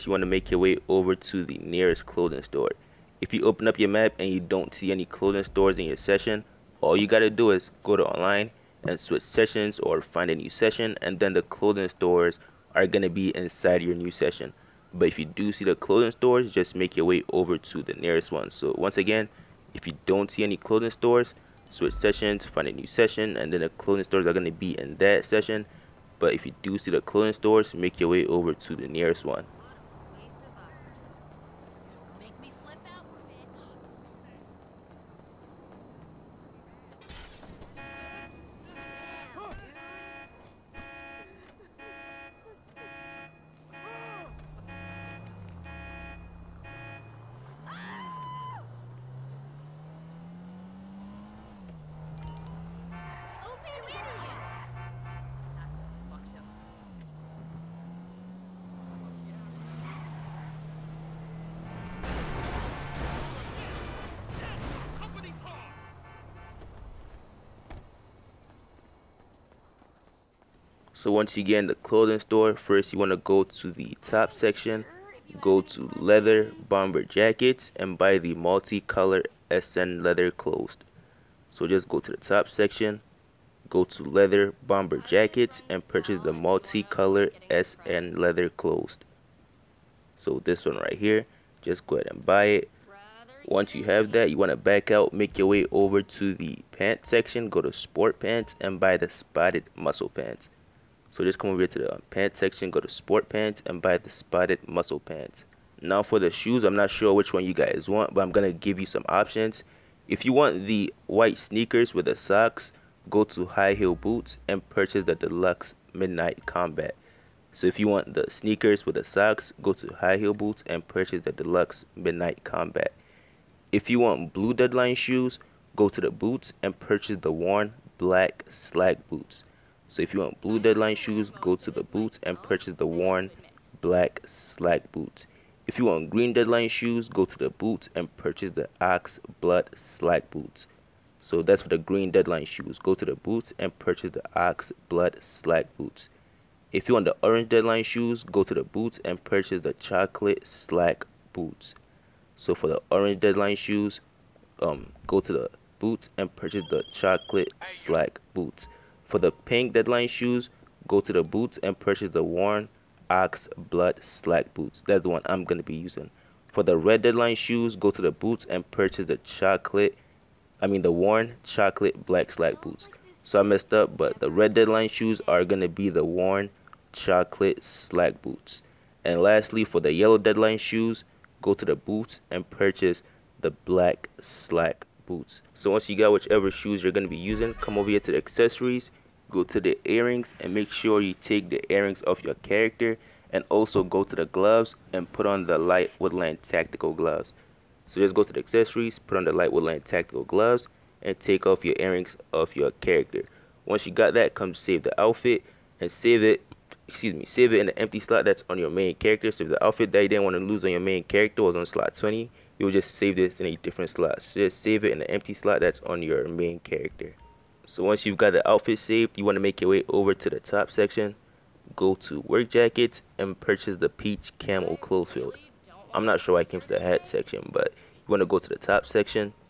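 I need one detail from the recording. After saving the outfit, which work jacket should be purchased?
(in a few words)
Peach camo closed field.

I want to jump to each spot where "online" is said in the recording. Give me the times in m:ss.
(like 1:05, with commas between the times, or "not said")
0:08.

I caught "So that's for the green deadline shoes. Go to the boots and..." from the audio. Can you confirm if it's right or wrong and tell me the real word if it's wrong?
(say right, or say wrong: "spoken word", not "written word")
right.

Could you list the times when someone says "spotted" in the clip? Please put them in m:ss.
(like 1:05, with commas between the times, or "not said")
1:39, 1:44.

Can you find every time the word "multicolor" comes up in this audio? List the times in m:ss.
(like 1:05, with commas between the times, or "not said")
1:18, 1:26.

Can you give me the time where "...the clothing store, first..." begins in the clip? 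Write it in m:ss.
1:11.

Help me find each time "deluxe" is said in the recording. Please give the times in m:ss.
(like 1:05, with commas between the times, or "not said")
1:55, 2:01.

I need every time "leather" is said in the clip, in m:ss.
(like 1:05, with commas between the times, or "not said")
1:15, 1:20, 1:24, 1:28.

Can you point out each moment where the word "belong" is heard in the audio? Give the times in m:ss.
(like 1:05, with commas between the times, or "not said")
not said.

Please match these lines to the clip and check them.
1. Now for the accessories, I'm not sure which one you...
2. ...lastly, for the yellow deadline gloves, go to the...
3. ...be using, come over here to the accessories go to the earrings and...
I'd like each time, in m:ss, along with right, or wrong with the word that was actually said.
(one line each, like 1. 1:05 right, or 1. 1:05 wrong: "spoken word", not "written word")
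1. 1:45 wrong: "shoes", not "accessories"
2. 2:59 wrong: "shoes", not "gloves"
3. 3:07 right.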